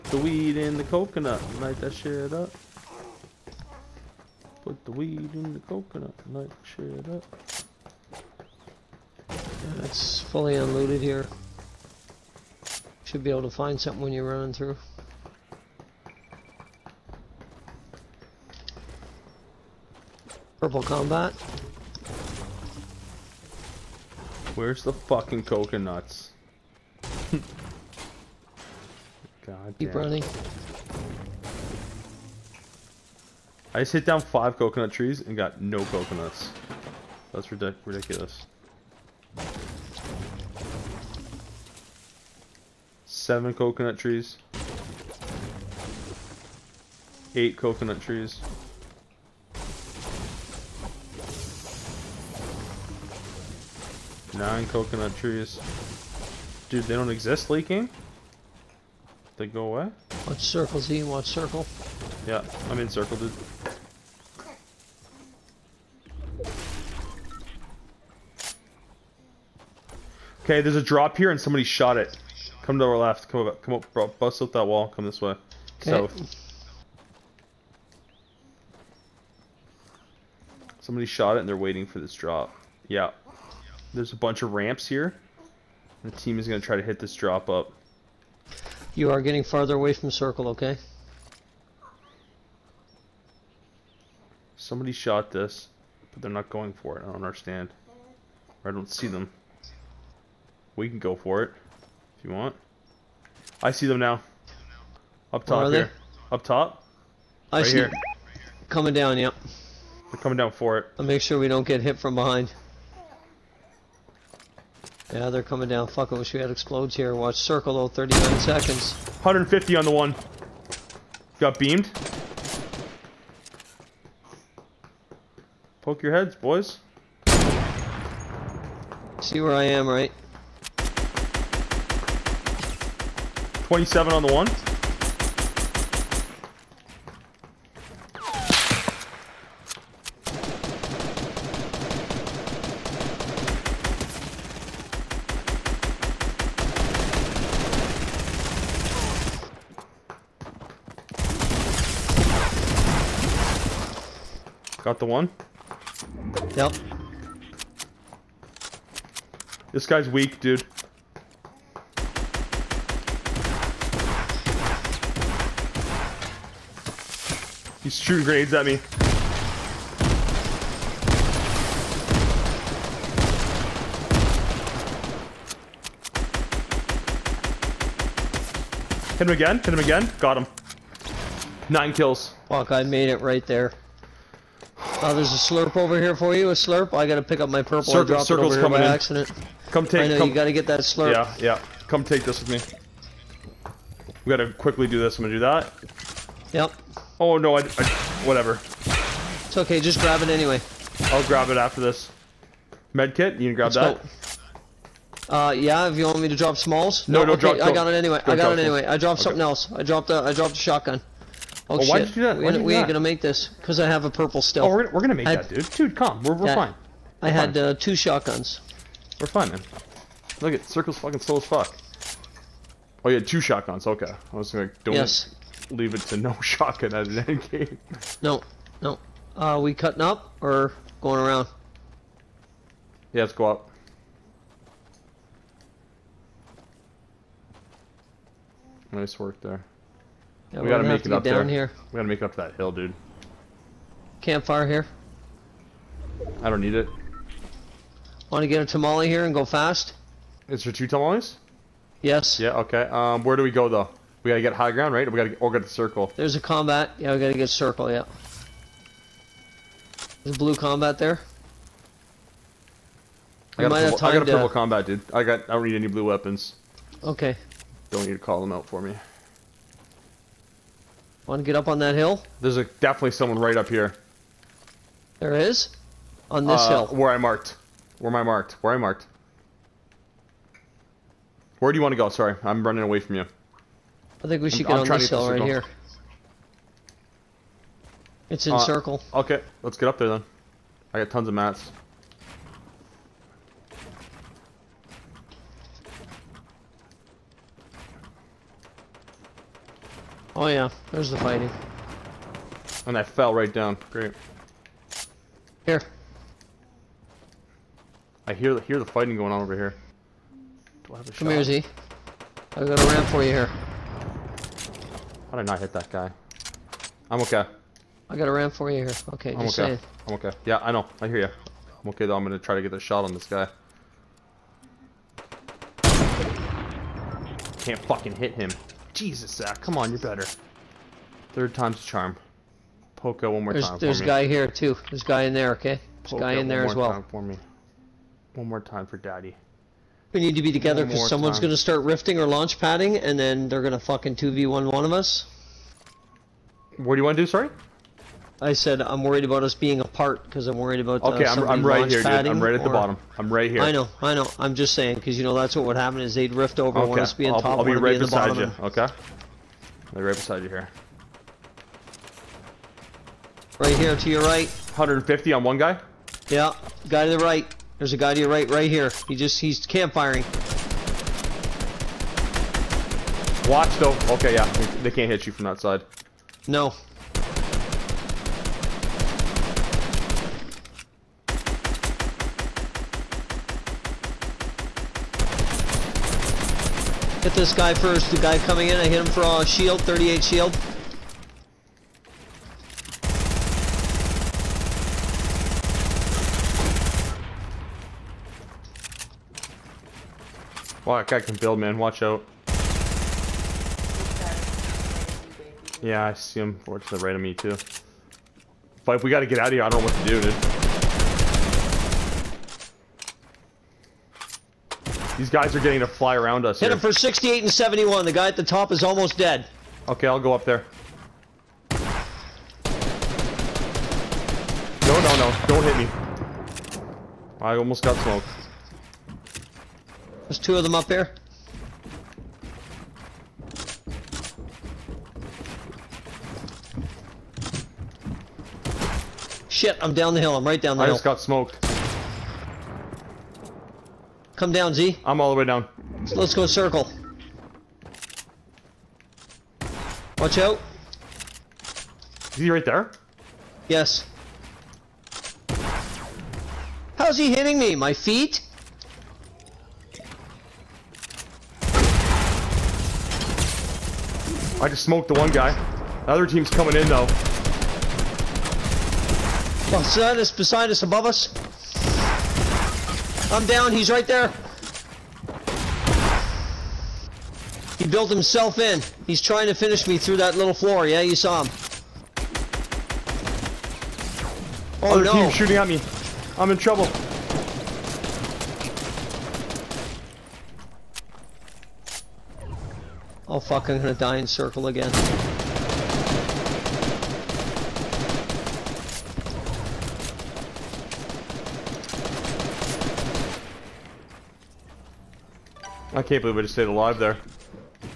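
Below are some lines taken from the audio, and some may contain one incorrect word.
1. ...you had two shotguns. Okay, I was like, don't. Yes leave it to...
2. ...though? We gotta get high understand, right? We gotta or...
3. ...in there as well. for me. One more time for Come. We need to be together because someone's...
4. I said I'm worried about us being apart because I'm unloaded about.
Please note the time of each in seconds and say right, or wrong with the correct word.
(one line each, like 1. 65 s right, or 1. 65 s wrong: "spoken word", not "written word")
1. 223 s right
2. 253 s wrong: "ground", not "understand"
3. 336 s wrong: "Daddy", not "Come"
4. 348 s wrong: "worried", not "unloaded".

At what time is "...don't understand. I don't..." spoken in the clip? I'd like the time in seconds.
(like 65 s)
97 s.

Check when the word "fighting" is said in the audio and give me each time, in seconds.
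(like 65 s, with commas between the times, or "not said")
301 s, 308 s.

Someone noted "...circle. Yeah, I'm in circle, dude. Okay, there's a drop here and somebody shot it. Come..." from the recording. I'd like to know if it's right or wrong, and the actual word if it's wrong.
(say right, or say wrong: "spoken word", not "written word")
right.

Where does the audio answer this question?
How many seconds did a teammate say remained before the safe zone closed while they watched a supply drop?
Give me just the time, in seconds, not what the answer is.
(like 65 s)
117 s.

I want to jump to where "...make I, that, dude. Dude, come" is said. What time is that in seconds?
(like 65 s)
215 s.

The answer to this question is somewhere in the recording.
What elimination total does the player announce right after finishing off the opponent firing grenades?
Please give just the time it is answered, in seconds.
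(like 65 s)
181 s.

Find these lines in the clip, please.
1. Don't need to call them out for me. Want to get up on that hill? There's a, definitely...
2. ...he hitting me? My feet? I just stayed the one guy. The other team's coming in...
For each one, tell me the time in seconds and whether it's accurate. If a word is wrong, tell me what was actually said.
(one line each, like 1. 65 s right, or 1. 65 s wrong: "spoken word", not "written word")
1. 267 s right
2. 457 s wrong: "smoked", not "stayed".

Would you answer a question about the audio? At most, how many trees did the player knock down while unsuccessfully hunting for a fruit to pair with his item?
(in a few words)
9.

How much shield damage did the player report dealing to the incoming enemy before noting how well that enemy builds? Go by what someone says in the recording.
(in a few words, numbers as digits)
38.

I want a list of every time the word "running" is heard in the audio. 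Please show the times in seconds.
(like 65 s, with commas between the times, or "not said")
14 s, 30 s, 282 s.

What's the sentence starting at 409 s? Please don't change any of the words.
I don't know what to do, dude.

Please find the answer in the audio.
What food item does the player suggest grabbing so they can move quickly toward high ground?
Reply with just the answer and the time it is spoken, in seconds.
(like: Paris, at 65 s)
tamale, at 248 s.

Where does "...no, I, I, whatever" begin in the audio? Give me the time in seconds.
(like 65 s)
197 s.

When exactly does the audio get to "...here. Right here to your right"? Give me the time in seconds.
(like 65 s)
360 s.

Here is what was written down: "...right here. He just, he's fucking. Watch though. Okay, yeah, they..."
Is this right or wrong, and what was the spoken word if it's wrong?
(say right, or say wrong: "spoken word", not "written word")
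wrong: "campfiring", not "fucking".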